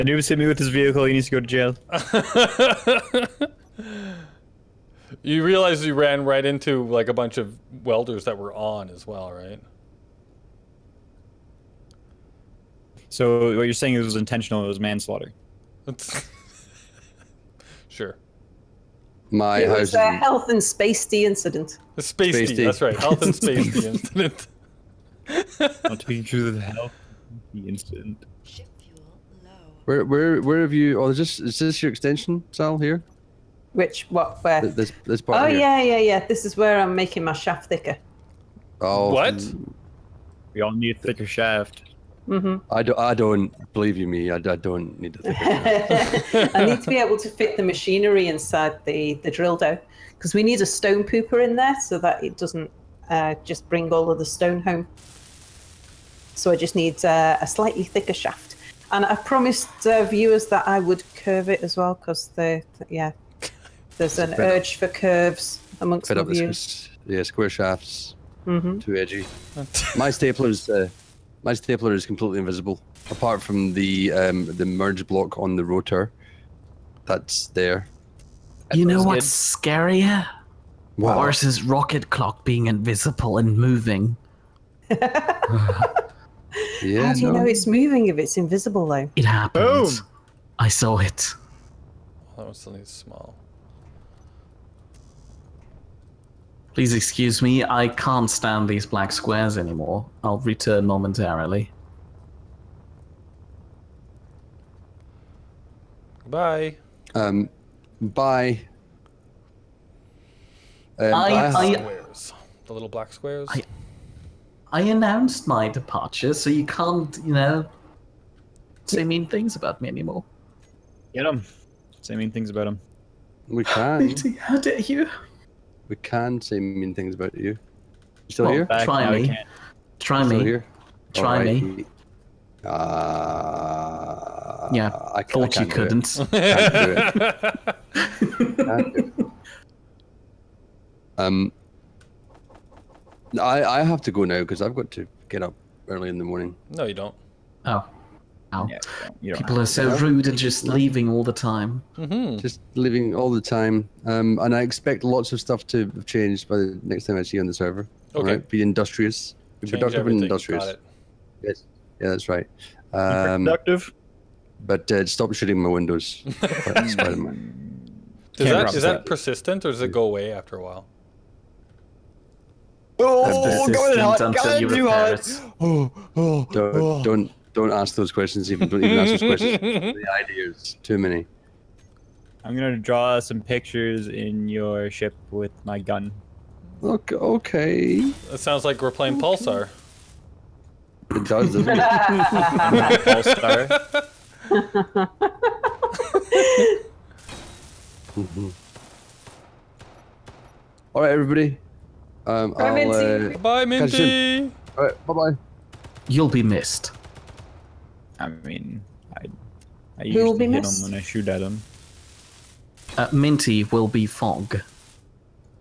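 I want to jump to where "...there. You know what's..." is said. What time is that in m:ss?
1:17.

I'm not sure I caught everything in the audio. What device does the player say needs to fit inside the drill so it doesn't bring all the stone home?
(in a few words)
stone pooper.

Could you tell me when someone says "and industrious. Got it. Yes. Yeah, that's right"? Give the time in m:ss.
2:40.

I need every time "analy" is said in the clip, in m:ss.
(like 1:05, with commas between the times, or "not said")
not said.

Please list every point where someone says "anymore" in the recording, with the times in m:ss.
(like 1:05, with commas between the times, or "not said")
1:39, 1:59.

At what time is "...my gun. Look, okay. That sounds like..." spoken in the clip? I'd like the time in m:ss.
3:05.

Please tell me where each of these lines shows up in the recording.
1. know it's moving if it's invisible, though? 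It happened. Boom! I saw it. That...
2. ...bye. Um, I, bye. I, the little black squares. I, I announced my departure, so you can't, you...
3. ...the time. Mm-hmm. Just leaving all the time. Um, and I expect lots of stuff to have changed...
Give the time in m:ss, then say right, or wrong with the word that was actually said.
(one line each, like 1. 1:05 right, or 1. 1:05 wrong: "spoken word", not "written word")
1. 1:27 right
2. 1:48 right
3. 2:31 right.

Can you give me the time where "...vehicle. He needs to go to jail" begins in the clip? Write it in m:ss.
0:00.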